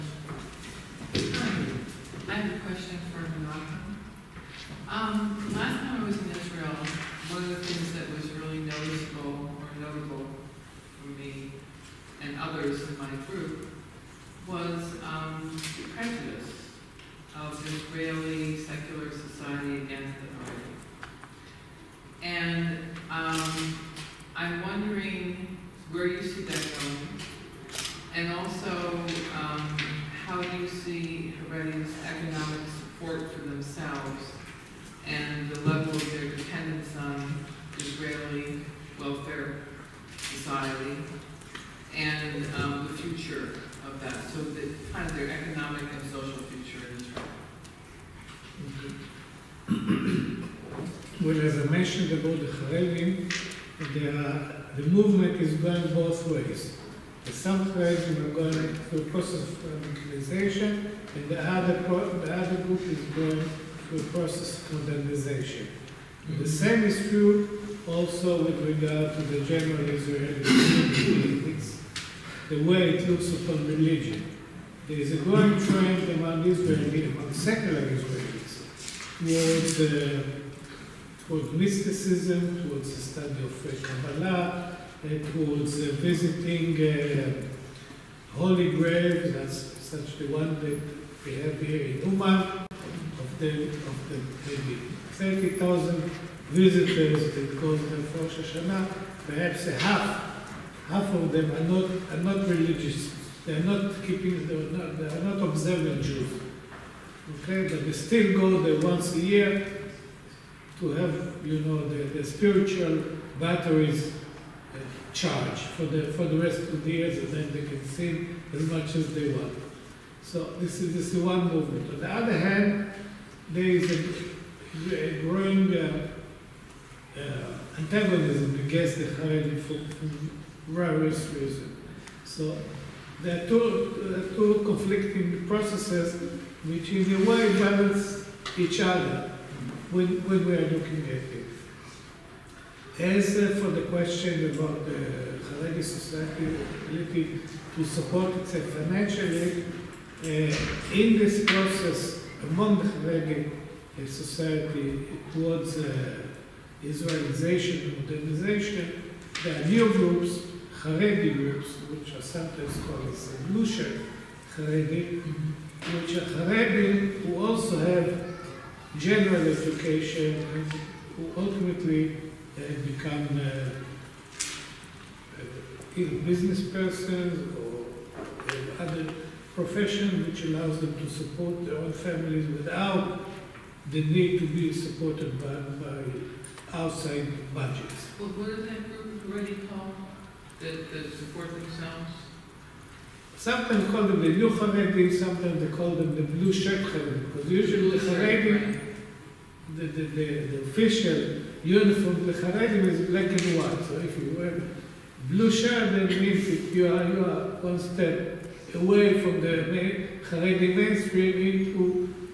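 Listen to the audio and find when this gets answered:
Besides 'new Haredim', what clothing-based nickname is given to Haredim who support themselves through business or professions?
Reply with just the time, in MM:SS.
03:16.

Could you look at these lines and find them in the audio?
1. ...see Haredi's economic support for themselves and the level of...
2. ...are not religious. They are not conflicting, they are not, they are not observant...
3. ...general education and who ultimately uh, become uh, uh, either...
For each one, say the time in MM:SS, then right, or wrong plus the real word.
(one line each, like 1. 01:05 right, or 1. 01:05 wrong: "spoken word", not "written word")
1. 00:30 right
2. 01:42 wrong: "keeping", not "conflicting"
3. 02:48 right.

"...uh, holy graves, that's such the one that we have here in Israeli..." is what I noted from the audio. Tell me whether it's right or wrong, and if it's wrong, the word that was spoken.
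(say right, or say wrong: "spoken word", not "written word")
wrong: "Uman", not "Israeli".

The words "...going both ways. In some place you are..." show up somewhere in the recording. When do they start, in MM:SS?
00:55.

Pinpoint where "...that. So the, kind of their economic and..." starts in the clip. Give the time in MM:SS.
00:44.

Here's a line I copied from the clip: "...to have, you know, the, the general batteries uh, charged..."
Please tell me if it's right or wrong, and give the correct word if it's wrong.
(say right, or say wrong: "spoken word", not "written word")
wrong: "spiritual", not "general".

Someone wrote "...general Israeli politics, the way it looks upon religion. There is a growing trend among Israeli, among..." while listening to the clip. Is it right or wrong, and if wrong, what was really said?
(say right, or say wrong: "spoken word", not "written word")
right.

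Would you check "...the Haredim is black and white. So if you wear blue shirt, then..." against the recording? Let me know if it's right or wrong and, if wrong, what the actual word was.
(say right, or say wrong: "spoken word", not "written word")
right.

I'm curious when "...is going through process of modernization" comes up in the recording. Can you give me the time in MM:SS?
01:02.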